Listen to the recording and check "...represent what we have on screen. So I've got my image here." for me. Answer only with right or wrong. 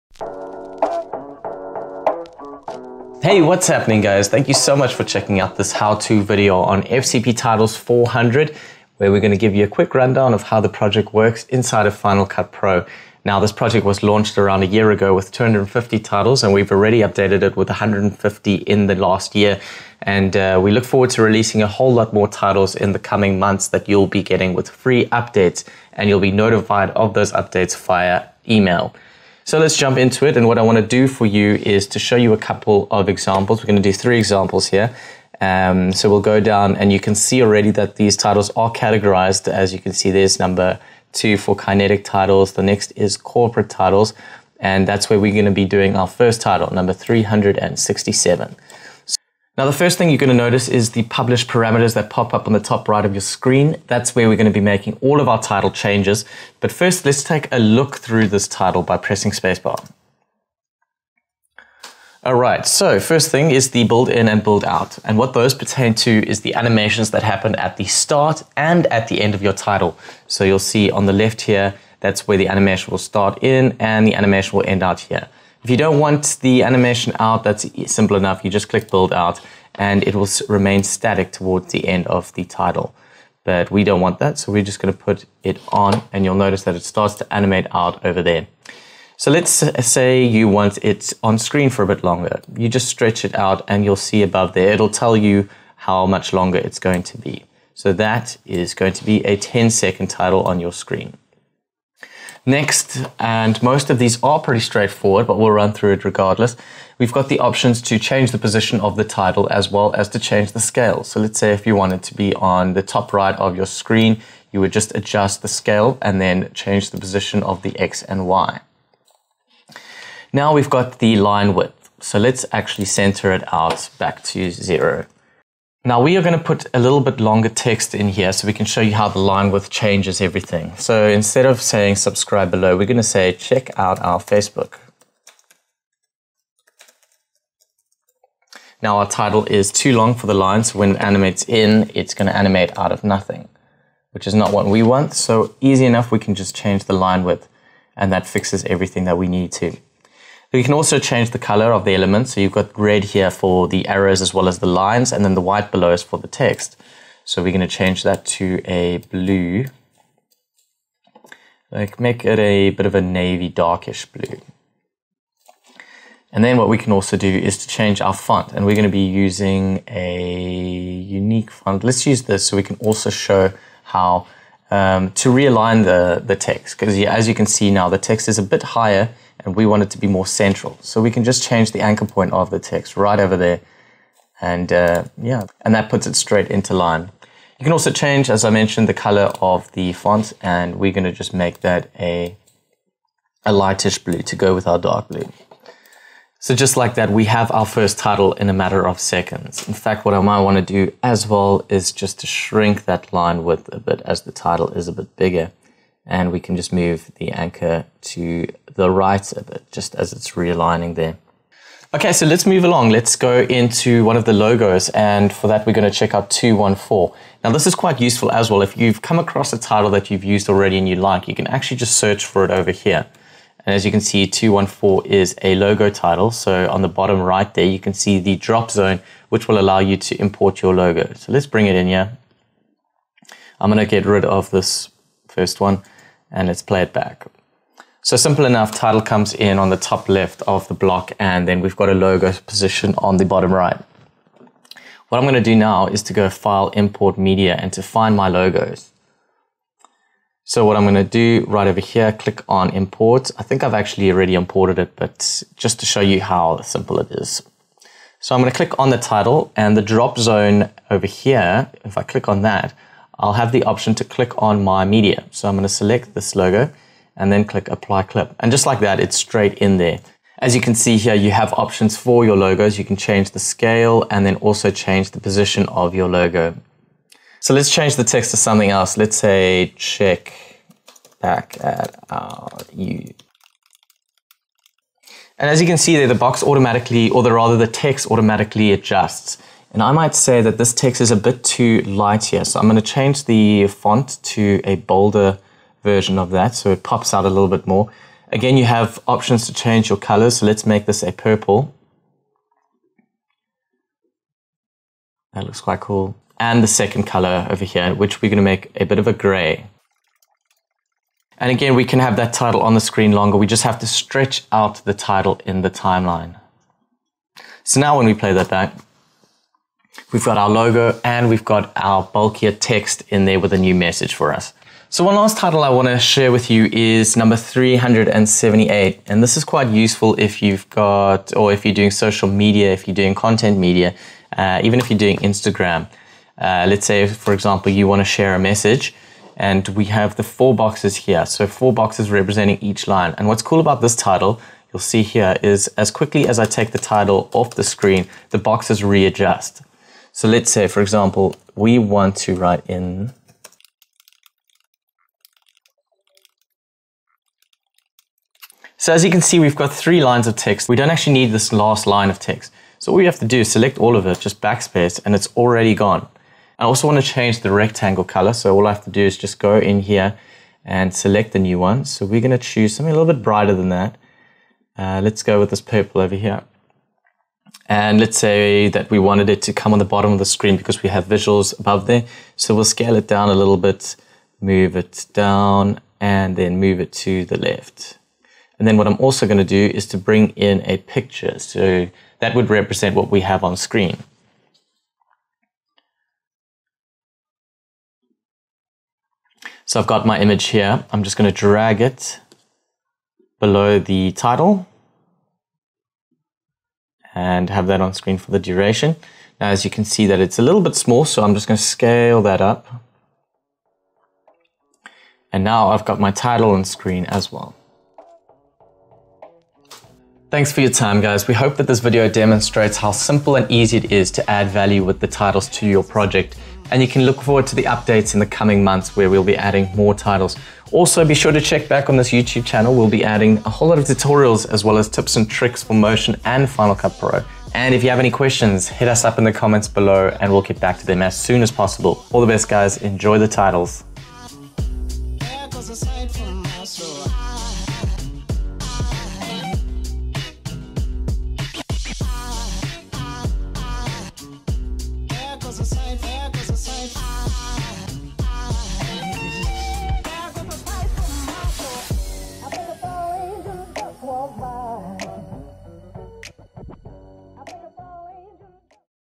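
right.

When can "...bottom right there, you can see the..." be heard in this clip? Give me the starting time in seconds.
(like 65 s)
226 s.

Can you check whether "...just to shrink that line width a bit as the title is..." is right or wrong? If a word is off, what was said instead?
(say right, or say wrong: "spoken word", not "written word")
right.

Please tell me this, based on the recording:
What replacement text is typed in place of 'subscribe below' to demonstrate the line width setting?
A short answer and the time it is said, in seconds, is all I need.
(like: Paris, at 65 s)
check out our Facebook, at 133 s.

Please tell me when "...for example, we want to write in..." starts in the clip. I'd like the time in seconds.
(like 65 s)
350 s.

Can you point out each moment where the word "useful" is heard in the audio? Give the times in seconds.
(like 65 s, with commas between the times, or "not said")
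218 s, 329 s.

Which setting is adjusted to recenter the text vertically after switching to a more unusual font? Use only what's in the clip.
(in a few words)
anchor point.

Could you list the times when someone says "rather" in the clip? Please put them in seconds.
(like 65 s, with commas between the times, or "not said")
287 s.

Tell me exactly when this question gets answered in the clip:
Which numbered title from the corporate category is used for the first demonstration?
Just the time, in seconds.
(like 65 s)
46 s.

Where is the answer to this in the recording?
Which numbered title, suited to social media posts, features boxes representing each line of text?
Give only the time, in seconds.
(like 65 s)
327 s.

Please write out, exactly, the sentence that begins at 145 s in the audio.
So easy enough, we can just change the line width and that fixes everything that we need to.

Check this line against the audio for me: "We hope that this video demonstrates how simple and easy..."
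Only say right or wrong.
right.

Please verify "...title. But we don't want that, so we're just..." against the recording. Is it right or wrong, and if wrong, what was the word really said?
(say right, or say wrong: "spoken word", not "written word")
right.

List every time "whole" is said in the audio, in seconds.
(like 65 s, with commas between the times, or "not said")
21 s, 433 s.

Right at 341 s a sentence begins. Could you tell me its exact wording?
So four boxes representing each line.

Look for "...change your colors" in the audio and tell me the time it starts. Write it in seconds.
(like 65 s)
299 s.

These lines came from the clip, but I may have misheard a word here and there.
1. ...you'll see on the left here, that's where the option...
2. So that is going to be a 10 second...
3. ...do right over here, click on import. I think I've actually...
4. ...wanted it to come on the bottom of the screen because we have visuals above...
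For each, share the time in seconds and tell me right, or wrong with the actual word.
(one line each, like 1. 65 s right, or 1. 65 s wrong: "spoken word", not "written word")
1. 70 s wrong: "animation", not "option"
2. 97 s right
3. 251 s right
4. 378 s right.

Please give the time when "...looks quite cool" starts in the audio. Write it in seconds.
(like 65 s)
305 s.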